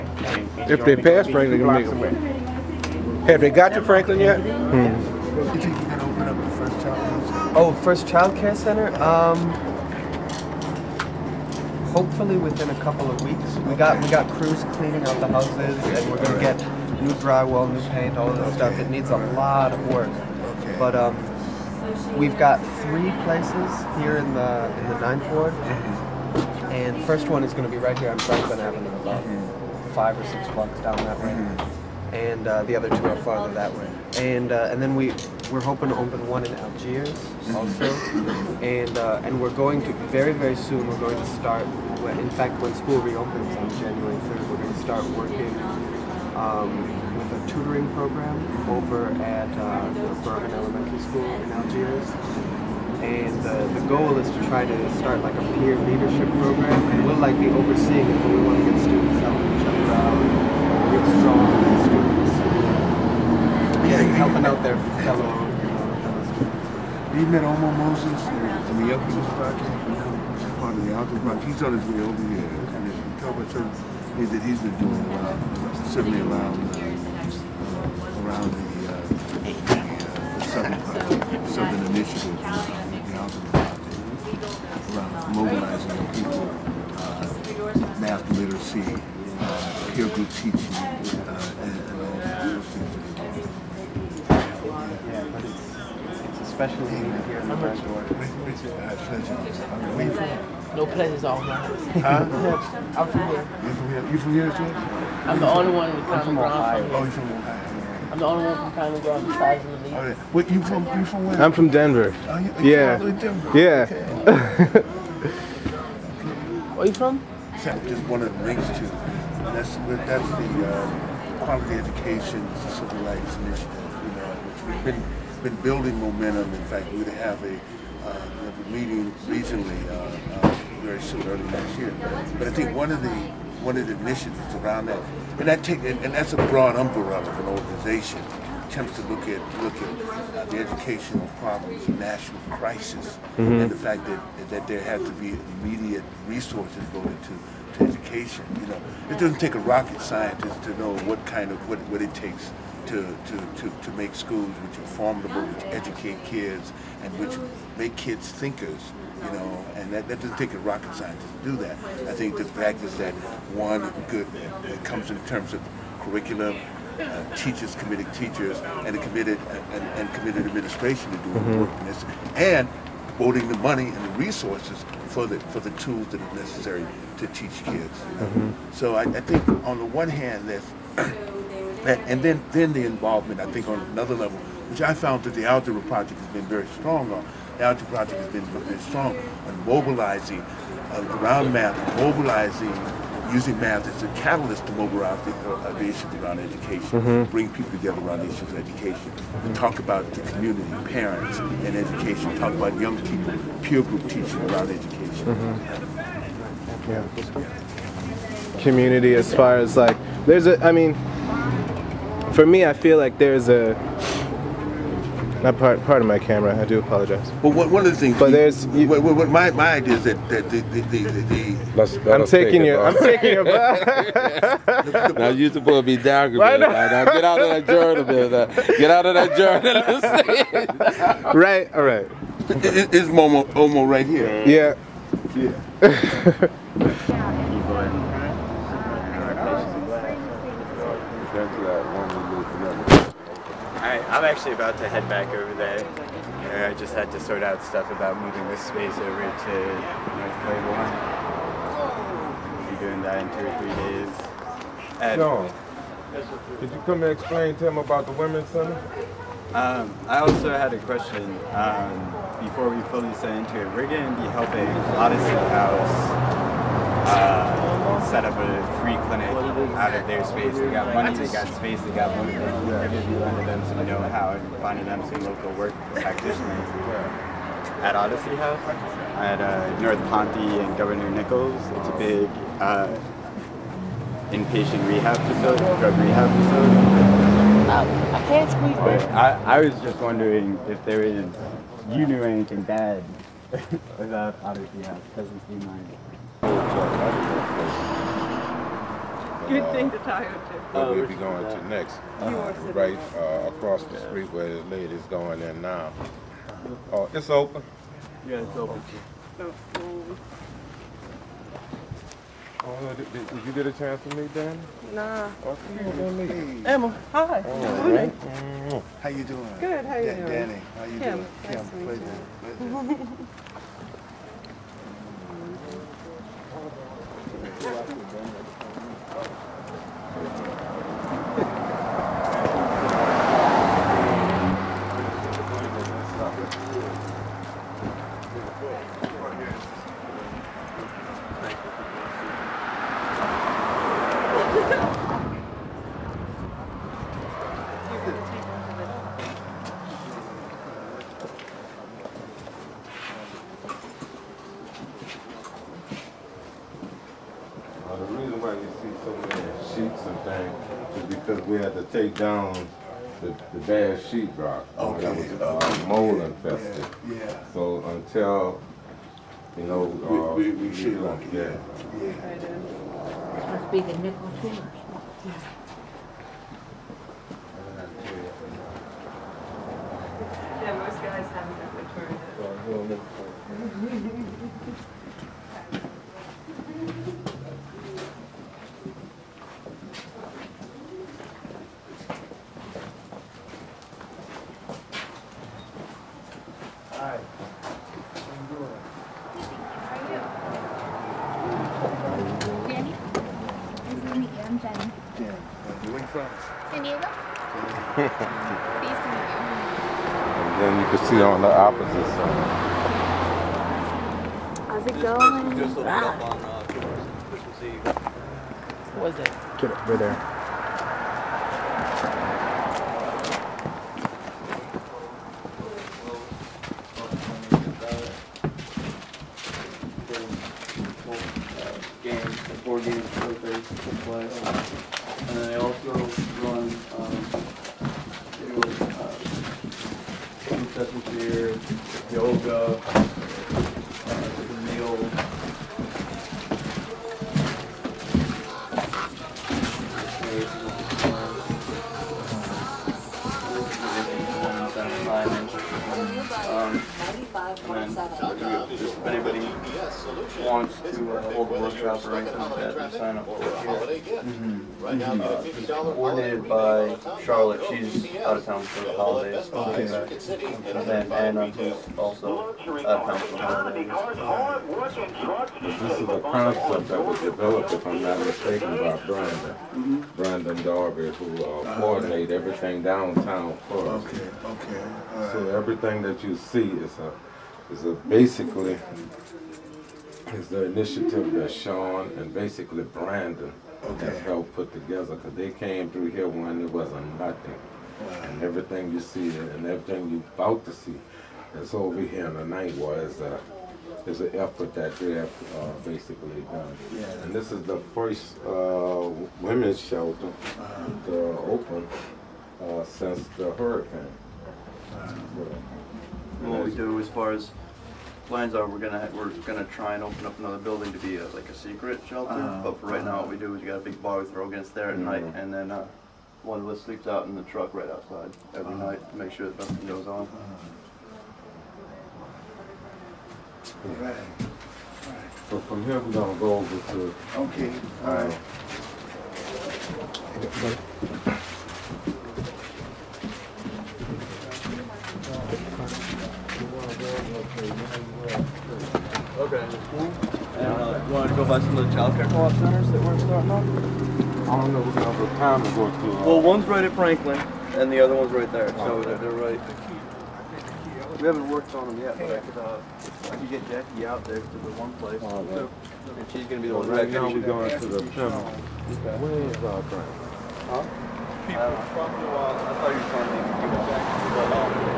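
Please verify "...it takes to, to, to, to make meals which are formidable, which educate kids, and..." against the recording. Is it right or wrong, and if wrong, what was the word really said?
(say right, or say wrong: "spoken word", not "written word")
wrong: "schools", not "meals".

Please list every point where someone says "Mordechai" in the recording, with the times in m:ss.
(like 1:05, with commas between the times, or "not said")
not said.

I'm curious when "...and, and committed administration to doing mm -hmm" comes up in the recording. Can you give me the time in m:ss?
2:49.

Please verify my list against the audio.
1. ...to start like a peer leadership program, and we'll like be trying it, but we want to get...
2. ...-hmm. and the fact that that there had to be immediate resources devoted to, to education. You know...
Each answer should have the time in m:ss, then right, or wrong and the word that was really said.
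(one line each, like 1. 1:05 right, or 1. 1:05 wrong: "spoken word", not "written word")
1. 0:54 wrong: "overseeing", not "trying"
2. 2:23 right.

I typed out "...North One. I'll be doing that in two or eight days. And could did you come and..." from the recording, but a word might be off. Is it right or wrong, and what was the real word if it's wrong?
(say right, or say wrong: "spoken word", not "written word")
wrong: "three", not "eight".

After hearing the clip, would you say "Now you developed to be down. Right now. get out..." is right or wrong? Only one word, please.
wrong.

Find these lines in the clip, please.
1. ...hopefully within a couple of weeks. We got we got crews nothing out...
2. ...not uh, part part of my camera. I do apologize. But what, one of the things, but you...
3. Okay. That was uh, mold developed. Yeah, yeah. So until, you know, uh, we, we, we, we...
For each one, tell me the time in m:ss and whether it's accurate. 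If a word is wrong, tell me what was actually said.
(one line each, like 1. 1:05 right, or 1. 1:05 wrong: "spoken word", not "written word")
1. 0:11 wrong: "cleaning", not "nothing"
2. 3:35 right
3. 6:04 wrong: "infested", not "developed".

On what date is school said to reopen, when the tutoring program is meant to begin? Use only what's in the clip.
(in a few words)
January 3.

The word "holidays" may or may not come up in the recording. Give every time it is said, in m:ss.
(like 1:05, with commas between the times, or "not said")
7:48, 7:53.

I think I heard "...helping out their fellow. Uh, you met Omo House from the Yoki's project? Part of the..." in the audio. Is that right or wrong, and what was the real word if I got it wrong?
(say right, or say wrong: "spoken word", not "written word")
wrong: "Moses", not "House".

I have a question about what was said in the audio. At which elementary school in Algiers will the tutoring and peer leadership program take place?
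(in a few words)
Bergen Elementary School.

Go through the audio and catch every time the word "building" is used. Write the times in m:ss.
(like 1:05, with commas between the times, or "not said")
2:05, 8:40.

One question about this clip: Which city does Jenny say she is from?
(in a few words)
San Diego.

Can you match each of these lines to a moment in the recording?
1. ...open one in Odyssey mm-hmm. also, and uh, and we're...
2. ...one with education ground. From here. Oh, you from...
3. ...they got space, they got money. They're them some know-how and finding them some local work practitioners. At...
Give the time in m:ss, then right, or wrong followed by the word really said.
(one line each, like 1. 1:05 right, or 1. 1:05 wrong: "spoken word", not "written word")
1. 0:35 wrong: "Algiers", not "Odyssey"
2. 1:45 wrong: "common", not "education"
3. 4:31 right.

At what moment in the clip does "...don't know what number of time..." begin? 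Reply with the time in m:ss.
9:14.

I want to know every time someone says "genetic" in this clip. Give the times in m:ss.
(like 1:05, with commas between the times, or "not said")
not said.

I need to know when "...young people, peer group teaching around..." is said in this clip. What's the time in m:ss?
3:22.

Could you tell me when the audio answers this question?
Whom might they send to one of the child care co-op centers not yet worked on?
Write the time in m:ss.
9:23.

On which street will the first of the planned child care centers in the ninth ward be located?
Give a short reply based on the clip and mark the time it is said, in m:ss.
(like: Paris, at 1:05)
Franklin Avenue, at 0:28.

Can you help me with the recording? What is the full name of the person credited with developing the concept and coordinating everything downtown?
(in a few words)
Brandon Darby.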